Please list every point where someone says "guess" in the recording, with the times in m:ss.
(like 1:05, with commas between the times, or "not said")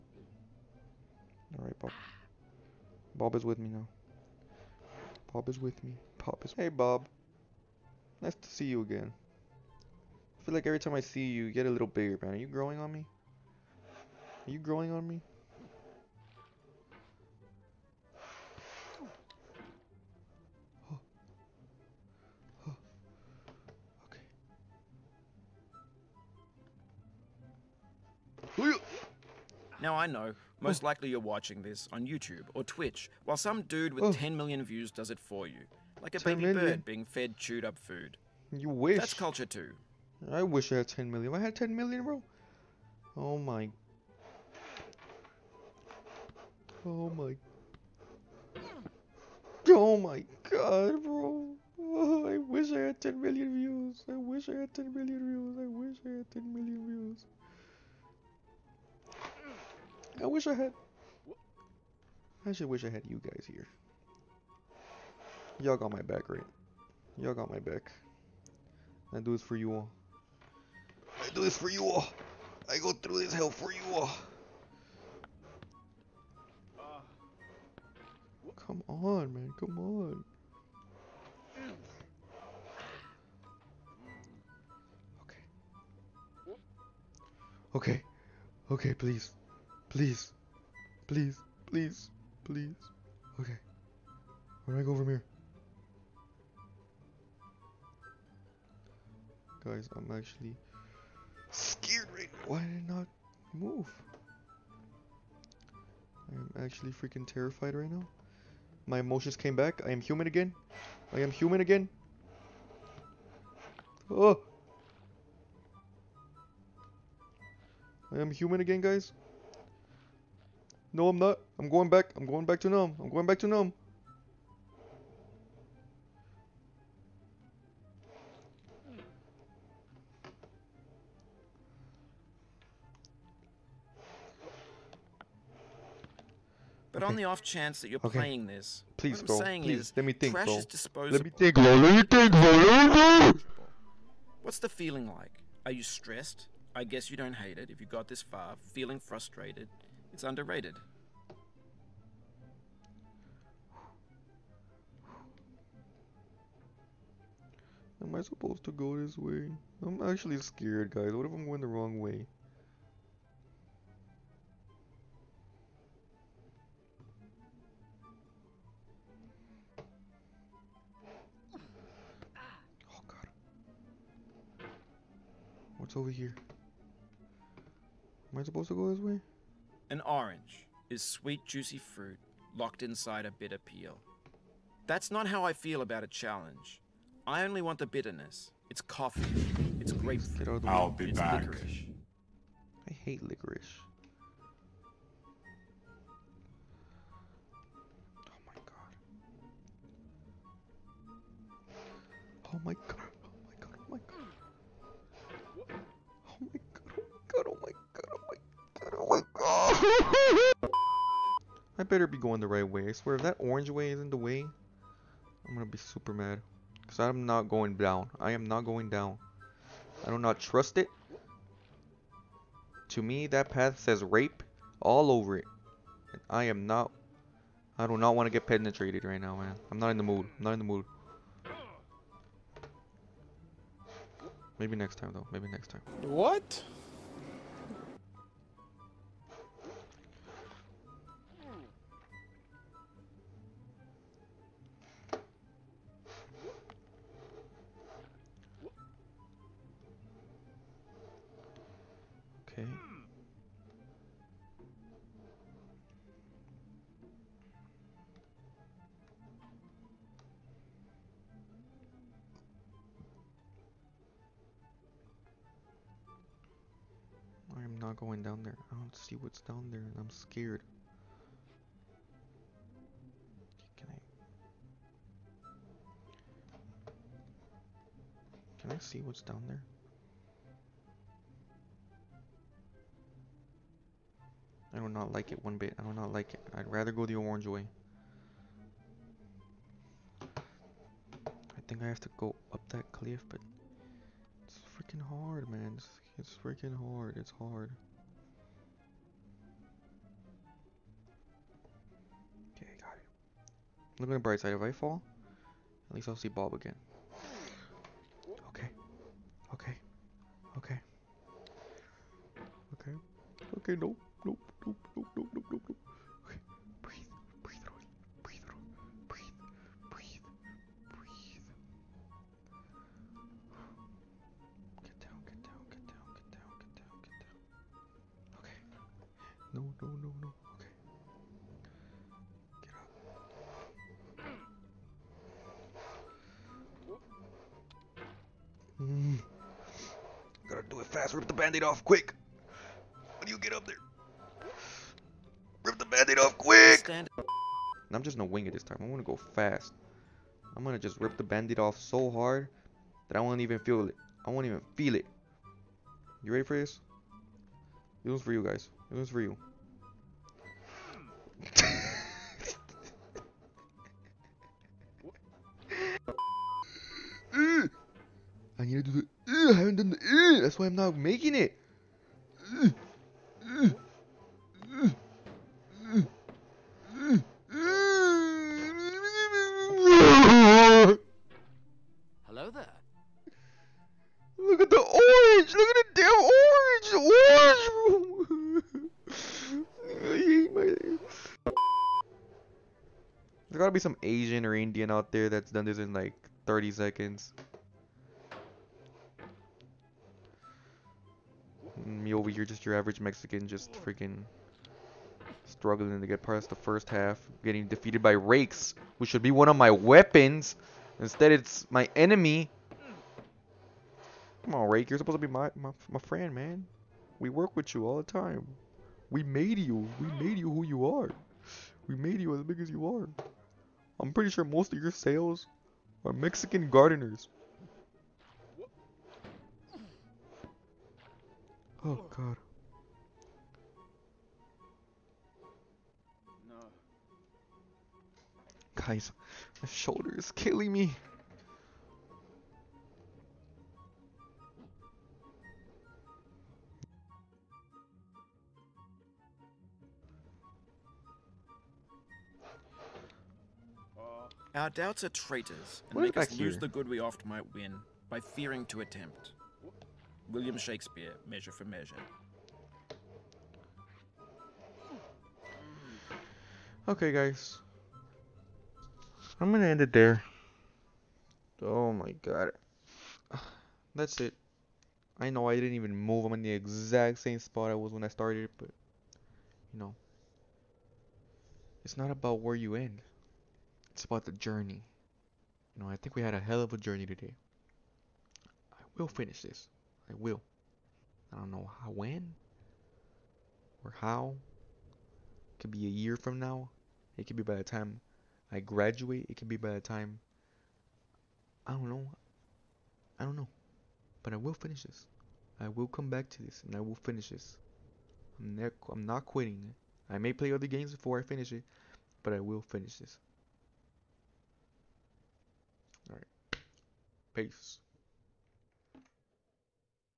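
2:26.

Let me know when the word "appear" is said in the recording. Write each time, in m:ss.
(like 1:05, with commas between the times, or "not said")
not said.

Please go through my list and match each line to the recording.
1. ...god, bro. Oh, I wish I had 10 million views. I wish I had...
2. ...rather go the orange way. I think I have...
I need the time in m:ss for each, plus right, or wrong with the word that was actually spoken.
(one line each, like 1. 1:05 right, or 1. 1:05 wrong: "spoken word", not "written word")
1. 0:50 right
2. 4:46 right.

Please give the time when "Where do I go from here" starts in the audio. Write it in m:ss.
1:34.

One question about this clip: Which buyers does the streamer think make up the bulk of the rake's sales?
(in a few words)
Mexican gardeners.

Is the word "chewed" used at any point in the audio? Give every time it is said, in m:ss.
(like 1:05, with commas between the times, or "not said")
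0:37.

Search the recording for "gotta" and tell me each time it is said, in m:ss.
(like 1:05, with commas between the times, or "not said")
5:40, 6:33.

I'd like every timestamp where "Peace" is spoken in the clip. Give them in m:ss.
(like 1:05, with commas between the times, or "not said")
8:37.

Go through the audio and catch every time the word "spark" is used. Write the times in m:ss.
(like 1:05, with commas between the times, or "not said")
not said.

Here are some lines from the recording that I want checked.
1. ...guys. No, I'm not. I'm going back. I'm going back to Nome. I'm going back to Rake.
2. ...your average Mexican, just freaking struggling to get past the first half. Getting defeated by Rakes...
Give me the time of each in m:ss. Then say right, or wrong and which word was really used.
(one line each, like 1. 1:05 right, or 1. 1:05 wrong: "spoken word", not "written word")
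1. 1:58 wrong: "Nome", not "Rake"
2. 6:42 right.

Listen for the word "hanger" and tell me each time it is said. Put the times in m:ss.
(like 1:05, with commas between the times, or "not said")
not said.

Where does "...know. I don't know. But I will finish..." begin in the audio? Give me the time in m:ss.
8:21.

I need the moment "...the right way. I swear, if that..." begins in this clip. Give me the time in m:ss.
3:32.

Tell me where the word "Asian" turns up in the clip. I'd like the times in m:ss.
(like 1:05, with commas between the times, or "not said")
6:34.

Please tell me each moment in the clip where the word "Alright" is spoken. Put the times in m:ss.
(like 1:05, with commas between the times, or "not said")
0:01.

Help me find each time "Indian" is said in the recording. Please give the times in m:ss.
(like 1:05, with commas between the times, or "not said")
6:34.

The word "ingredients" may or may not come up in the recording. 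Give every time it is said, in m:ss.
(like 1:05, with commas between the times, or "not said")
not said.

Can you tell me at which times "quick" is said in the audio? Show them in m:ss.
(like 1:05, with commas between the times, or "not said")
5:41, 5:46.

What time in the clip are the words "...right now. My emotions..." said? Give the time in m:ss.
1:47.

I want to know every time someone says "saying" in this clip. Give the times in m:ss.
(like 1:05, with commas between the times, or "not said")
2:19.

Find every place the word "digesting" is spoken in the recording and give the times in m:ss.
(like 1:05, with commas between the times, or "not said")
not said.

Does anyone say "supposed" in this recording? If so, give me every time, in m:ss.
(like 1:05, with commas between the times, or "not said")
2:38, 2:58, 6:54.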